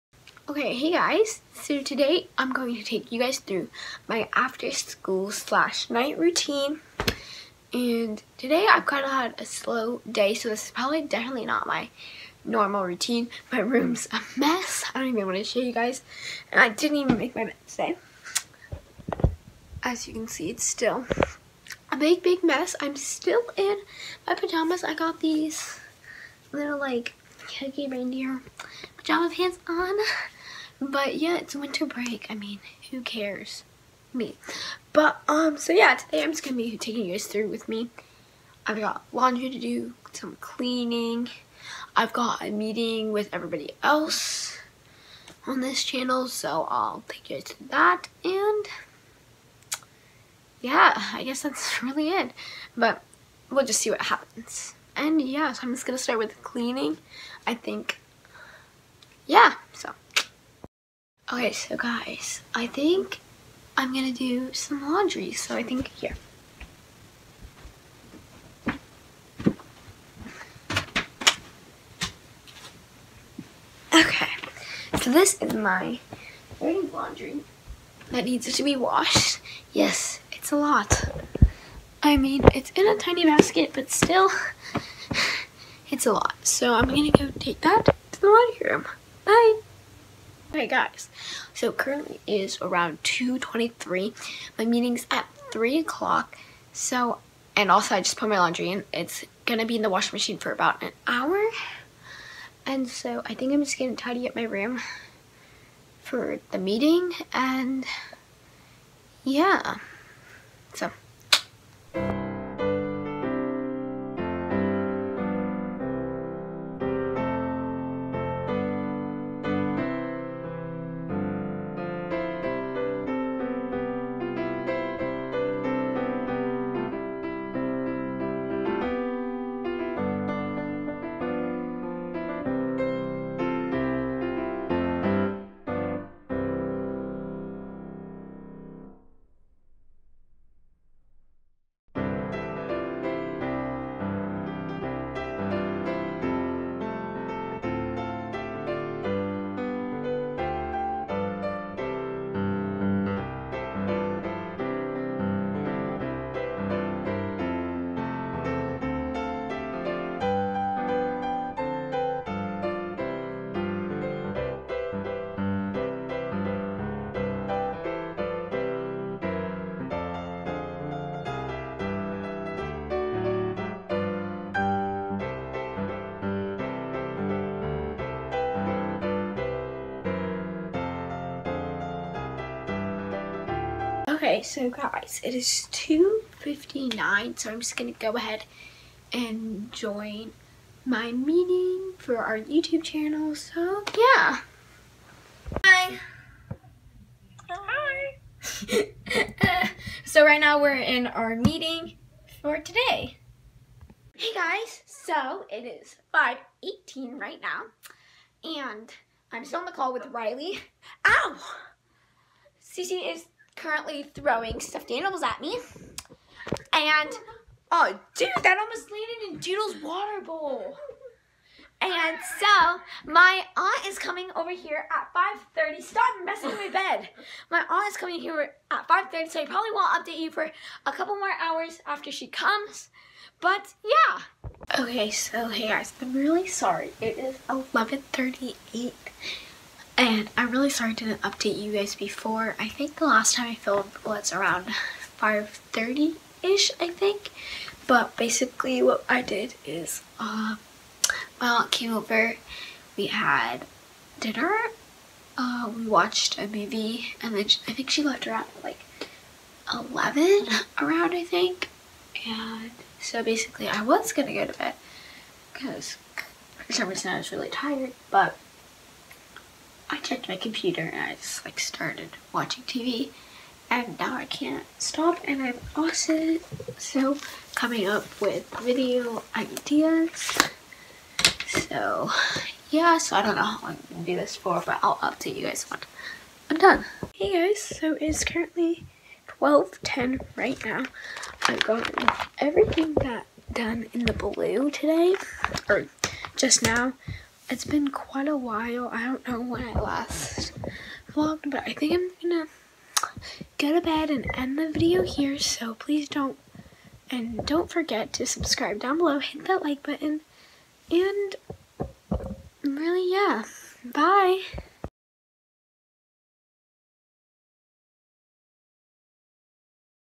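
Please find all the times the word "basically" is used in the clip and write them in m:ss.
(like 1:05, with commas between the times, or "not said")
4:08, 4:23.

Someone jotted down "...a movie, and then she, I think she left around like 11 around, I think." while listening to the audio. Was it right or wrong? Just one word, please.
right.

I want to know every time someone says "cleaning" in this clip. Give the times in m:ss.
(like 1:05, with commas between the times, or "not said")
0:40, 0:56.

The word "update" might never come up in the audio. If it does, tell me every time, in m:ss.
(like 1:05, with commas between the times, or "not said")
3:50, 4:01, 4:44.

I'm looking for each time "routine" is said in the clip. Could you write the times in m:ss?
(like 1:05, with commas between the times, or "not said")
0:06, 0:12.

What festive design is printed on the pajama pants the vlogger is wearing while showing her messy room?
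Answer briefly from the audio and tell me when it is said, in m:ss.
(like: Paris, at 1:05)
cookie reindeer, at 0:27.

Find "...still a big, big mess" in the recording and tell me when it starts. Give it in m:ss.
0:20.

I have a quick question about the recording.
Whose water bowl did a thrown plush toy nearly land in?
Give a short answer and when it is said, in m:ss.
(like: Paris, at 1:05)
Doodle's, at 3:39.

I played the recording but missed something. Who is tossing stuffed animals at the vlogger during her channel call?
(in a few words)
Cece.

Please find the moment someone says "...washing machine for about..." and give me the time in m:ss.
1:39.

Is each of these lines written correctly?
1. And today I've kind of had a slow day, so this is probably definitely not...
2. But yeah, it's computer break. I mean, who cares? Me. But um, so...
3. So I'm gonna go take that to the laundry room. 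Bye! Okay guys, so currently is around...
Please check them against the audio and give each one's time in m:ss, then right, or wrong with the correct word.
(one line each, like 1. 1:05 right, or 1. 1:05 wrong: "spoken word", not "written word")
1. 0:07 right
2. 0:30 wrong: "winter", not "computer"
3. 1:26 right.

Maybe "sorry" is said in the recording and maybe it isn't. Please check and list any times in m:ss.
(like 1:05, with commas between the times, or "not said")
3:56, 4:00.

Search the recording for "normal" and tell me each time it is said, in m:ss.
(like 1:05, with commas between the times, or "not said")
0:12.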